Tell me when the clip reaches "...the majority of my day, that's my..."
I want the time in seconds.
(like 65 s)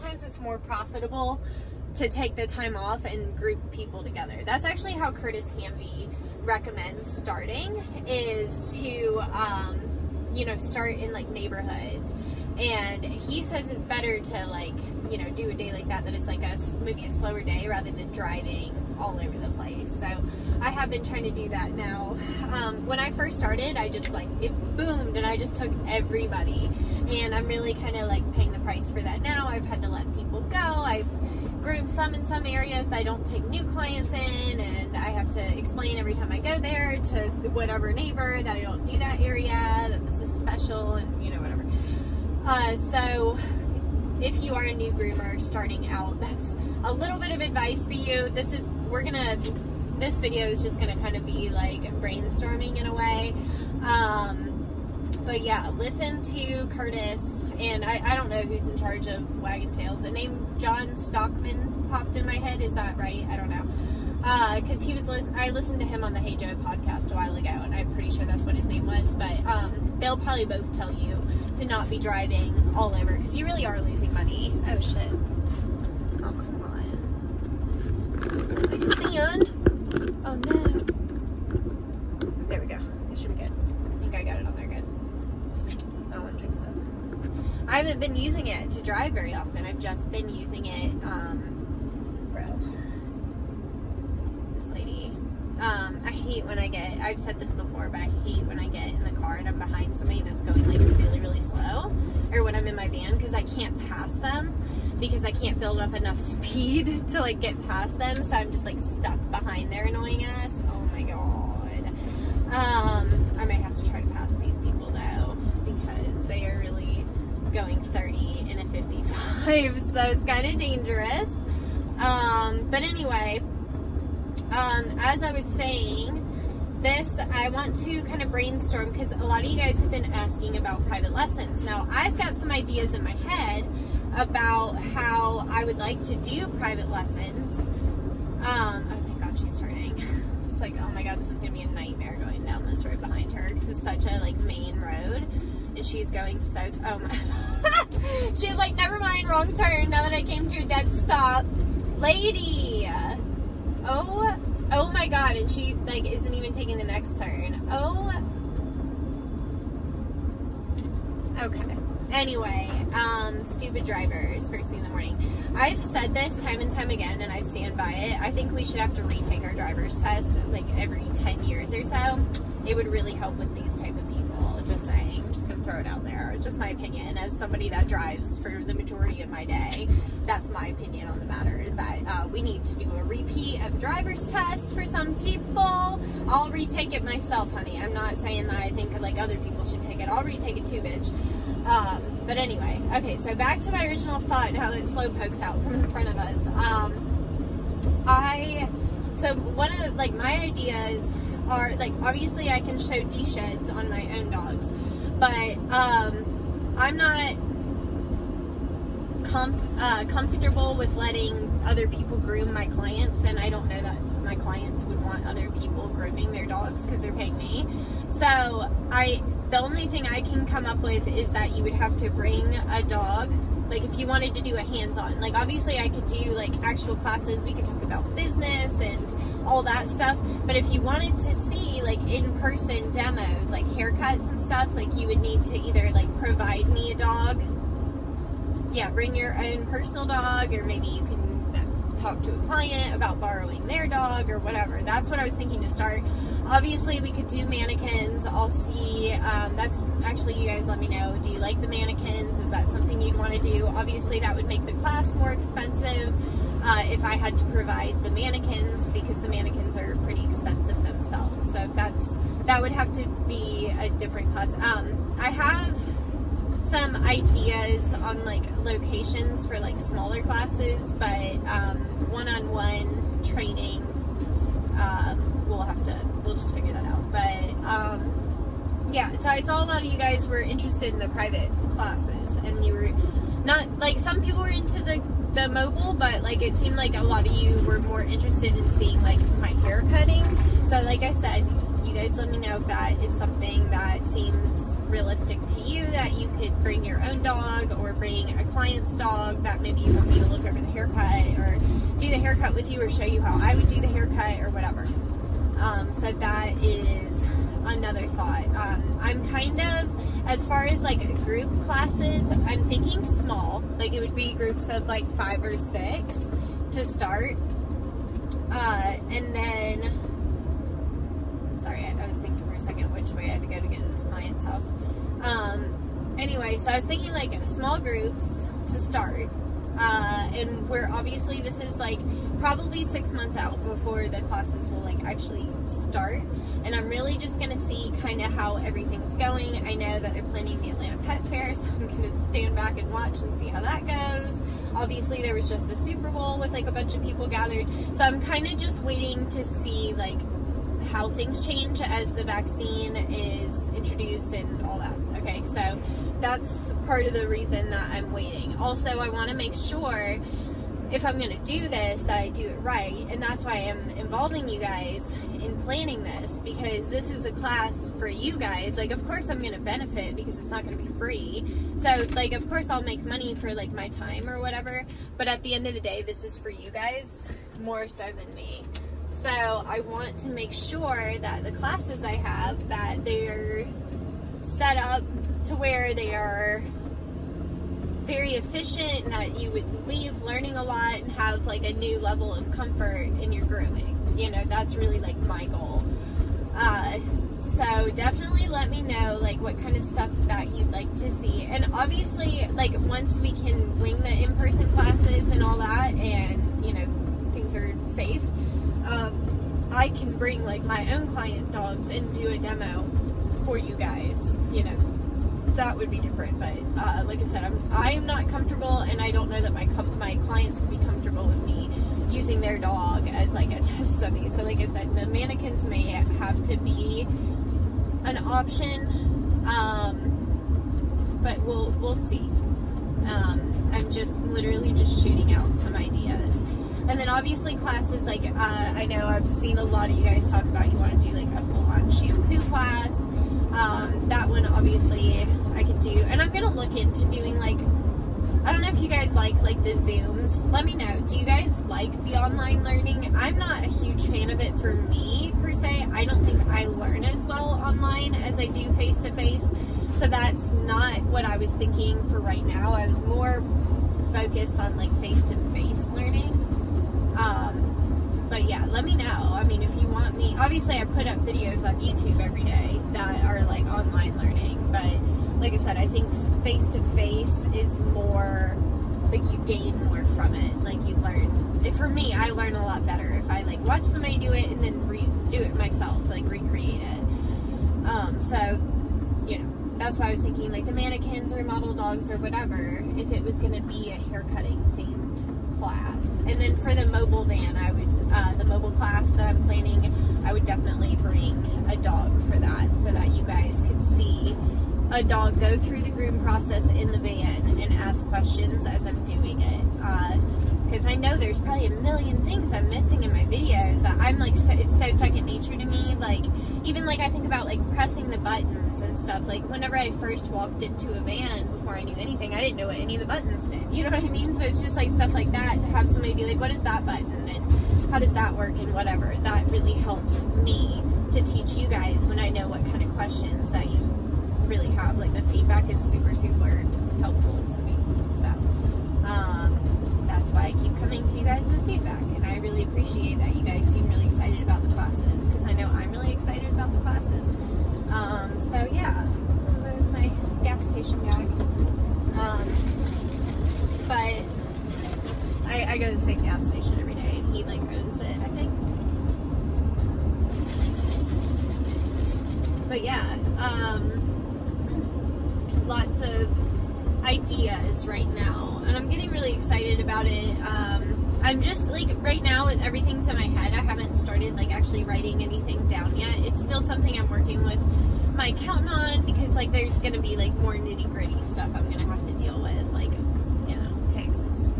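178 s.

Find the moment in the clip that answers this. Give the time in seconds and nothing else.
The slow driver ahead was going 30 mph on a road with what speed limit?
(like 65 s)
118 s.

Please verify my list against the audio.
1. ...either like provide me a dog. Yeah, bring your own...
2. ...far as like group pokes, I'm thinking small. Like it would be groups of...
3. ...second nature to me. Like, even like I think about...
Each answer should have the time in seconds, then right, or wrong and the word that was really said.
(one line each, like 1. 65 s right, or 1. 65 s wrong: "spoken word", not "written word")
1. 235 s right
2. 310 s wrong: "classes", not "pokes"
3. 514 s right.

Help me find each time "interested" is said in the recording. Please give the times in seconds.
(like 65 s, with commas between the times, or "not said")
280 s, 288 s.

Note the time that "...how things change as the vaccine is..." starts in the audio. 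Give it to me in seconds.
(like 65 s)
350 s.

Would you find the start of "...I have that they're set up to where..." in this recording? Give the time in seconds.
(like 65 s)
382 s.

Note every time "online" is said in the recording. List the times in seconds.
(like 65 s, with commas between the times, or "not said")
452 s, 457 s, 473 s.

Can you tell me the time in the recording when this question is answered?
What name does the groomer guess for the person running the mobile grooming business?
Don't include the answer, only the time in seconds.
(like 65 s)
60 s.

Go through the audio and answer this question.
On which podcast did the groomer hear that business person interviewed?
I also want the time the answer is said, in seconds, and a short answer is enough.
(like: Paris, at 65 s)
Hey Joe, at 66 s.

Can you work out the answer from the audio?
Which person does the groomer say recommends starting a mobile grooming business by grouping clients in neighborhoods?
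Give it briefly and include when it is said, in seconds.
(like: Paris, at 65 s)
Curtis Hamby, at 5 s.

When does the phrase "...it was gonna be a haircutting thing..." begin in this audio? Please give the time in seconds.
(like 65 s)
493 s.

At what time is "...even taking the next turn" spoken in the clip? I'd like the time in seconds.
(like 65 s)
156 s.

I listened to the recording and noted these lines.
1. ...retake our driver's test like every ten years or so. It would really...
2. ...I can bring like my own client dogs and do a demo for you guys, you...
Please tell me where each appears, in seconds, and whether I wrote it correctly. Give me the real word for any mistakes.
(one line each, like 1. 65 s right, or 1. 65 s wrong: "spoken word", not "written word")
1. 169 s right
2. 409 s right.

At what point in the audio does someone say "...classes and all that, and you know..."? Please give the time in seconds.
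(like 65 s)
404 s.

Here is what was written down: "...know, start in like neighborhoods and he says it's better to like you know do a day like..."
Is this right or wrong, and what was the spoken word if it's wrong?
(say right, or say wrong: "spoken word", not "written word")
right.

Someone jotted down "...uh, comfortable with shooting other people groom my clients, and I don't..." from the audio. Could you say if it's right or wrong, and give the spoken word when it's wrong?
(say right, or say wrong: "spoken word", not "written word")
wrong: "letting", not "shooting".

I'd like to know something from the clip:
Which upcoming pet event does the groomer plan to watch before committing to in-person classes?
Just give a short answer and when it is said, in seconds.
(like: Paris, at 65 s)
Atlanta Pet Fair, at 340 s.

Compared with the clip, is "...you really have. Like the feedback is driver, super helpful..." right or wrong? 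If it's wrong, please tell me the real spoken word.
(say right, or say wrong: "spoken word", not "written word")
wrong: "super", not "driver".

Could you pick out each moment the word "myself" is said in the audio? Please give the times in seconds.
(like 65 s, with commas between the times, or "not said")
187 s, 485 s.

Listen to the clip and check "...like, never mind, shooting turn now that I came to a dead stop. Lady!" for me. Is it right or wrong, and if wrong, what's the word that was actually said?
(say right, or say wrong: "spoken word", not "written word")
wrong: "wrong", not "shooting".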